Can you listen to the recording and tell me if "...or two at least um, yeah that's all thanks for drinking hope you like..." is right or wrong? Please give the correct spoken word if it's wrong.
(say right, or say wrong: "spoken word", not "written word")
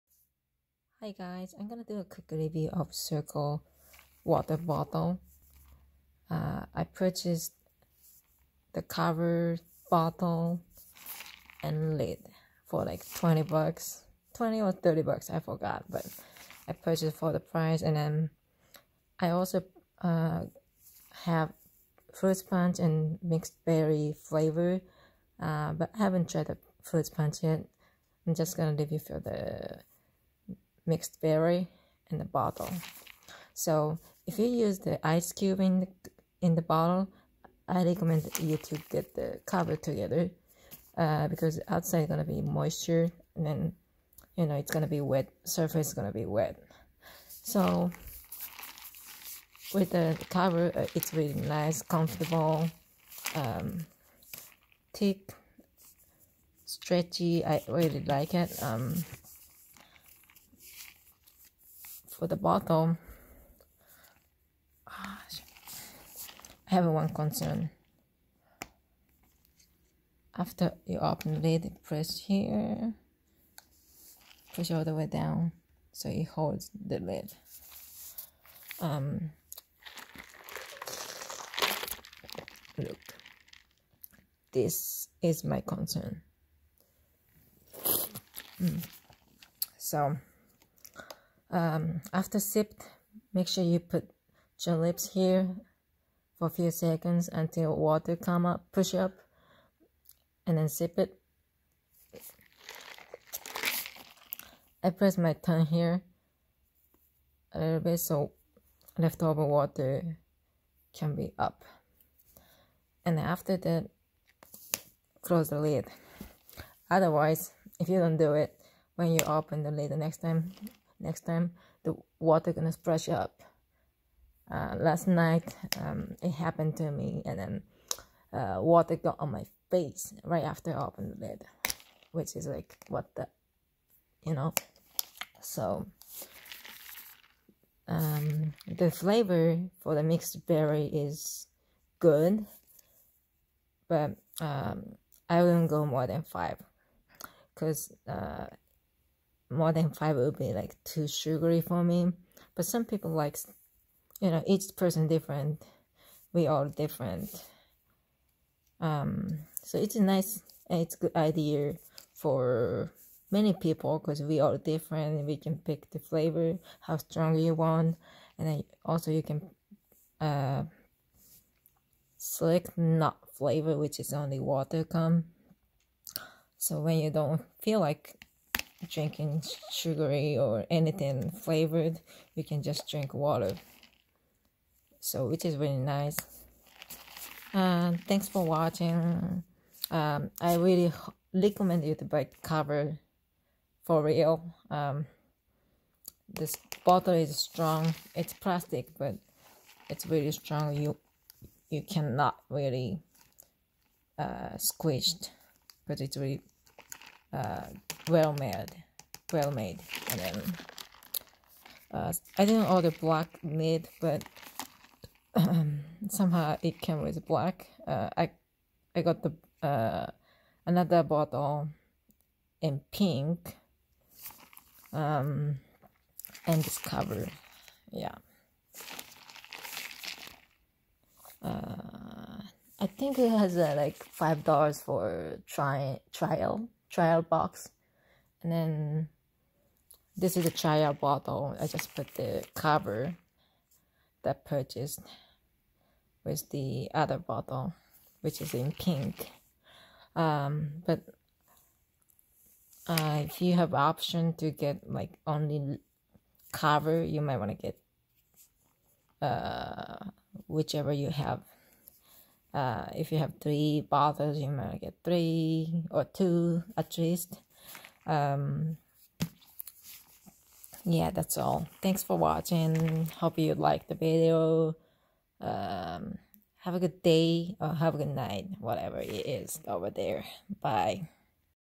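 wrong: "watching", not "drinking".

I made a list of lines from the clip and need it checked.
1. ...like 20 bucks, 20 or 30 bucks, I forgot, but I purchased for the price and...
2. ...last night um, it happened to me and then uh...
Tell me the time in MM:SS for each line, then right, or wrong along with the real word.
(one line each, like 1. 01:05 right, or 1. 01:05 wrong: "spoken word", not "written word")
1. 00:12 right
2. 02:04 right.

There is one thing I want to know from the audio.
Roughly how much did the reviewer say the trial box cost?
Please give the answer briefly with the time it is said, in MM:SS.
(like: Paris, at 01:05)
$5, at 03:53.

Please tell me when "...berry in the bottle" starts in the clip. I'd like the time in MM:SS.
00:31.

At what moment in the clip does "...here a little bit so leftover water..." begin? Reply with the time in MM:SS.
01:45.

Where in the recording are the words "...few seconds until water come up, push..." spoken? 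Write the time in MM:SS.
01:36.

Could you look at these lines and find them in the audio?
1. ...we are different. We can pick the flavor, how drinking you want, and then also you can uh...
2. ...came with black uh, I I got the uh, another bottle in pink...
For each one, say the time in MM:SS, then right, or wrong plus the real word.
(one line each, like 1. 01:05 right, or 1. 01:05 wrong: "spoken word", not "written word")
1. 02:44 wrong: "strong", not "drinking"
2. 03:36 right.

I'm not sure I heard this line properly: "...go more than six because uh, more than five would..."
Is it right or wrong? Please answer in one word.
wrong.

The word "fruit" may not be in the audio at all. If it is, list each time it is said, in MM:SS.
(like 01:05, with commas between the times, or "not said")
00:22, 00:26.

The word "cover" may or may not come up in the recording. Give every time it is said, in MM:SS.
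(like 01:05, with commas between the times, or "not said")
00:08, 00:39, 00:50, 03:12, 03:46, 04:02, 04:16.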